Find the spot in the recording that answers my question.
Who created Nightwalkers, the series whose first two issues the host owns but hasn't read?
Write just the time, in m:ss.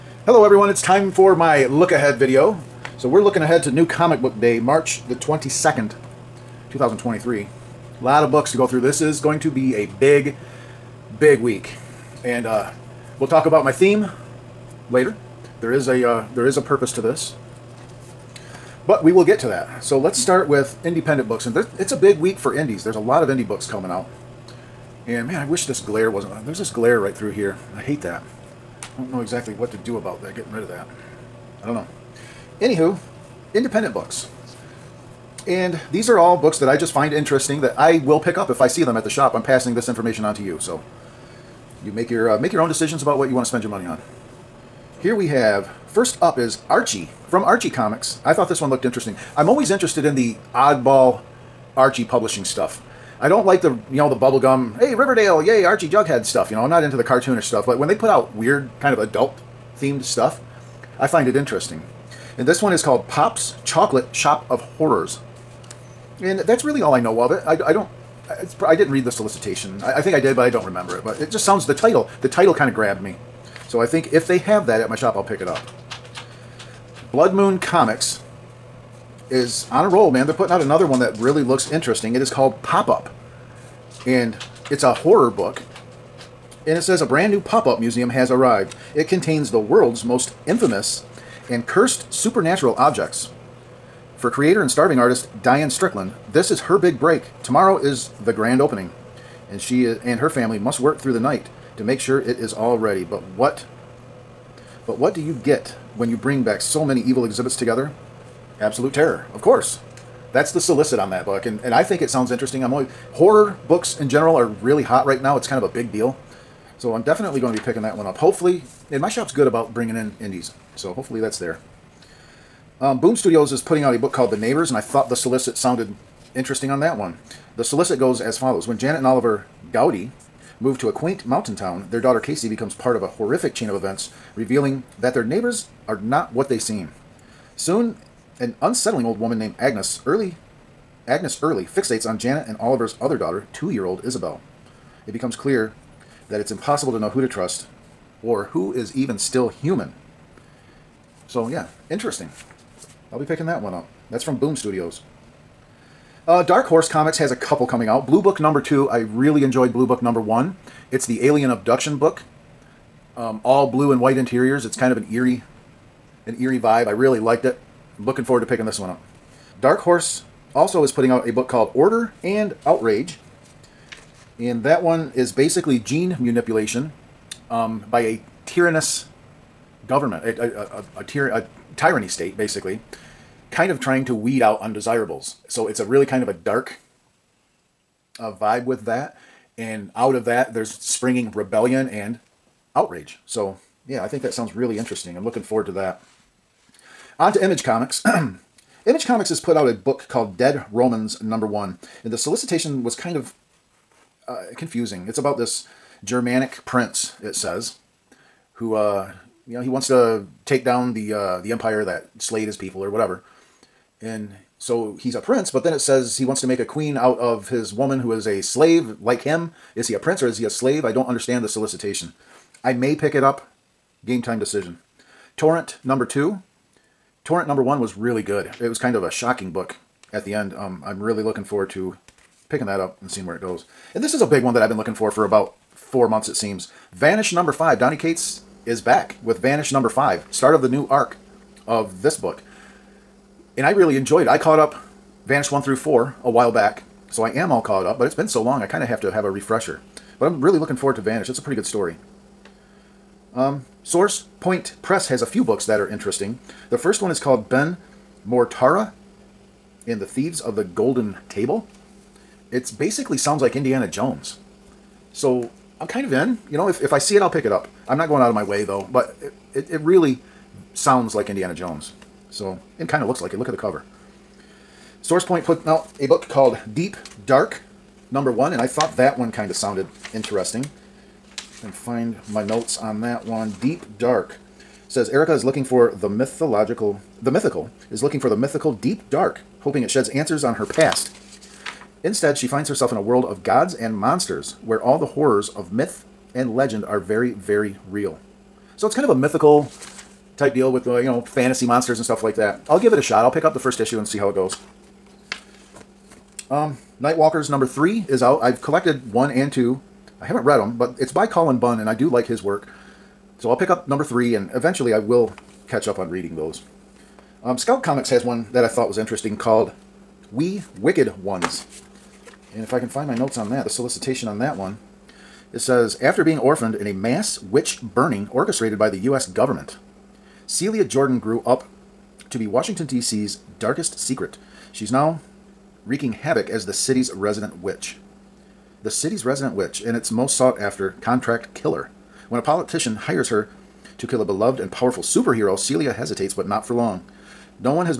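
5:11.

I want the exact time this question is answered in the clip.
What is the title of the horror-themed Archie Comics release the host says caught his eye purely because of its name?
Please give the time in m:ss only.
1:03.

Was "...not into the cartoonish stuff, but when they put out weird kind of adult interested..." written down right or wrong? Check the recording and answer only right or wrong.
wrong.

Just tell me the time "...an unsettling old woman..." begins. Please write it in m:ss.
2:18.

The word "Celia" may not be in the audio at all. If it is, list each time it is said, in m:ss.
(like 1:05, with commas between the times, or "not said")
5:30, 5:45.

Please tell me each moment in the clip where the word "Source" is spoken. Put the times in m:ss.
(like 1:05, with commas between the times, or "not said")
4:13, 4:35.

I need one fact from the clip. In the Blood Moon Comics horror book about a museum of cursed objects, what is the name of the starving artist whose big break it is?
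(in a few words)
Diane Strickland.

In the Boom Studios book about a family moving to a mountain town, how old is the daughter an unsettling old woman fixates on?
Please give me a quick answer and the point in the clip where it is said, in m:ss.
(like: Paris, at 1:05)
2, at 2:23.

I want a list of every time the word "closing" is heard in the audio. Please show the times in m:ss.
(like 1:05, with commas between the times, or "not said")
not said.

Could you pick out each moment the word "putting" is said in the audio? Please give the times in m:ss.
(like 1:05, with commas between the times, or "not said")
1:20, 2:03, 2:50.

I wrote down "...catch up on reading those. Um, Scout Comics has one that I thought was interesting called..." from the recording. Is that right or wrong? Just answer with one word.
right.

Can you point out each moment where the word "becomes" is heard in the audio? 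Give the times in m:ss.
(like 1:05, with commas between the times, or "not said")
2:12, 2:25.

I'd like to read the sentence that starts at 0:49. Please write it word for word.
I'm always interested in the oddball Archie publishing stuff.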